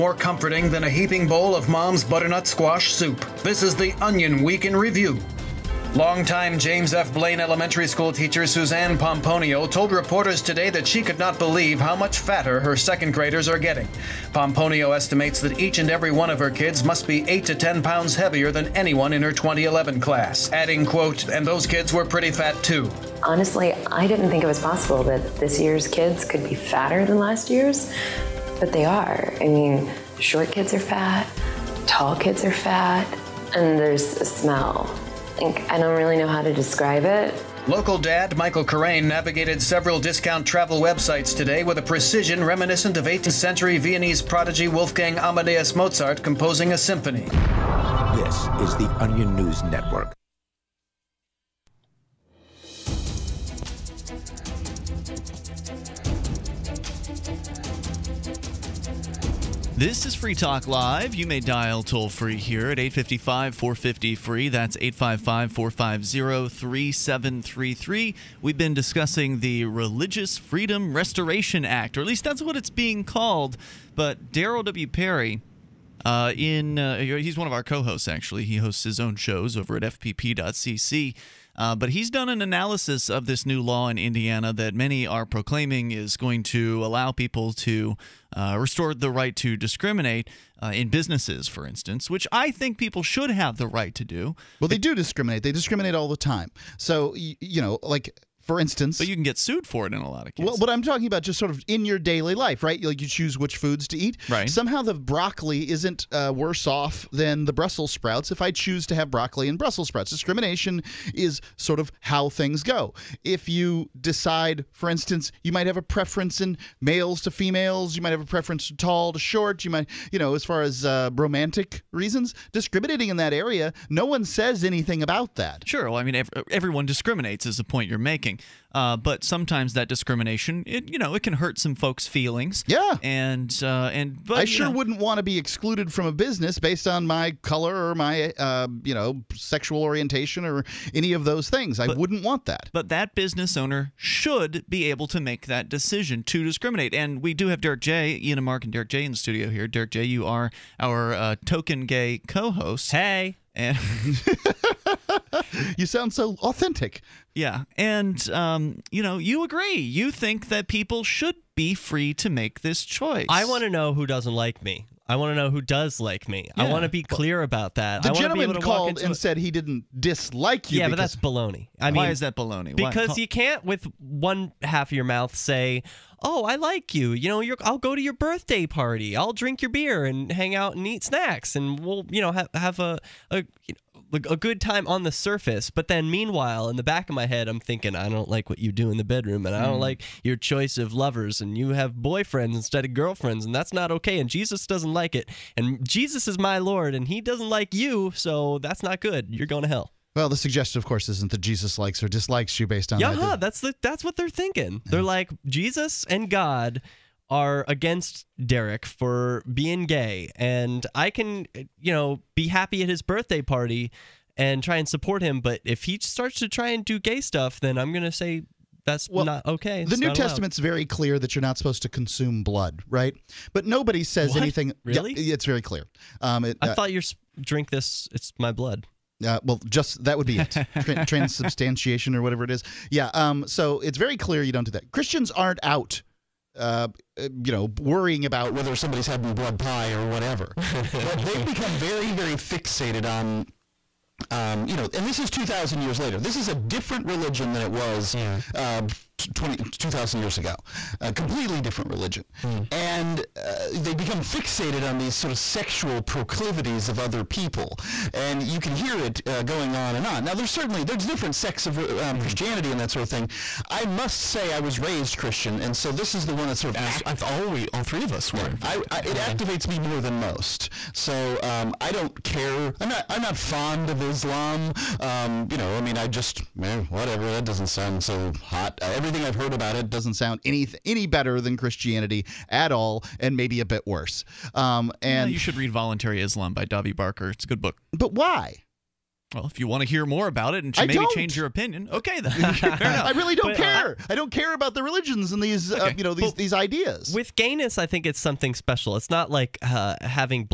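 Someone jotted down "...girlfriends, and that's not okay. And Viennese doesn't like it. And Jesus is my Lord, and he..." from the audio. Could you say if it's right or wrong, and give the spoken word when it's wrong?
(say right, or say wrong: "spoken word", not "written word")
wrong: "Jesus", not "Viennese".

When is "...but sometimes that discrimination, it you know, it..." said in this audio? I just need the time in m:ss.
2:08.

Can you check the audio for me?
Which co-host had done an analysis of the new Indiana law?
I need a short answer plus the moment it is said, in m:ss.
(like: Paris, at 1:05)
Darryl W. Perry, at 1:14.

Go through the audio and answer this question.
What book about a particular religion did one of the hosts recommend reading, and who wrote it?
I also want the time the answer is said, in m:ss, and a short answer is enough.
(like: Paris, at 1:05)
Voluntary Islam by Davi Barker, at 4:45.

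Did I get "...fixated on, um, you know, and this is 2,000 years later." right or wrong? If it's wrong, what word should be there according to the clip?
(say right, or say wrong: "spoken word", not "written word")
right.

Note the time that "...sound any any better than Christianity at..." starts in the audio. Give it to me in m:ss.
4:40.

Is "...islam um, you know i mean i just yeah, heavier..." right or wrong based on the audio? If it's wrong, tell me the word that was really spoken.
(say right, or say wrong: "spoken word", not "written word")
wrong: "whatever", not "heavier".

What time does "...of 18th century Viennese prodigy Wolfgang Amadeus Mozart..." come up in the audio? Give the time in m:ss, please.
0:42.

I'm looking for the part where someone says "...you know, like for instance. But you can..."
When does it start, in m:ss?
1:37.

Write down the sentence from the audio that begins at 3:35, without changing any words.
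But if he starts to try and do gay stuff, then I'm gonna say that's well, not okay.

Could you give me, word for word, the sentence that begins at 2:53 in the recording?
you can't with one half of your mouth say, "Oh, I like you." You know, I'll go to your birthday party.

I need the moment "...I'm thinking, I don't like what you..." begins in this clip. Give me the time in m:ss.
3:07.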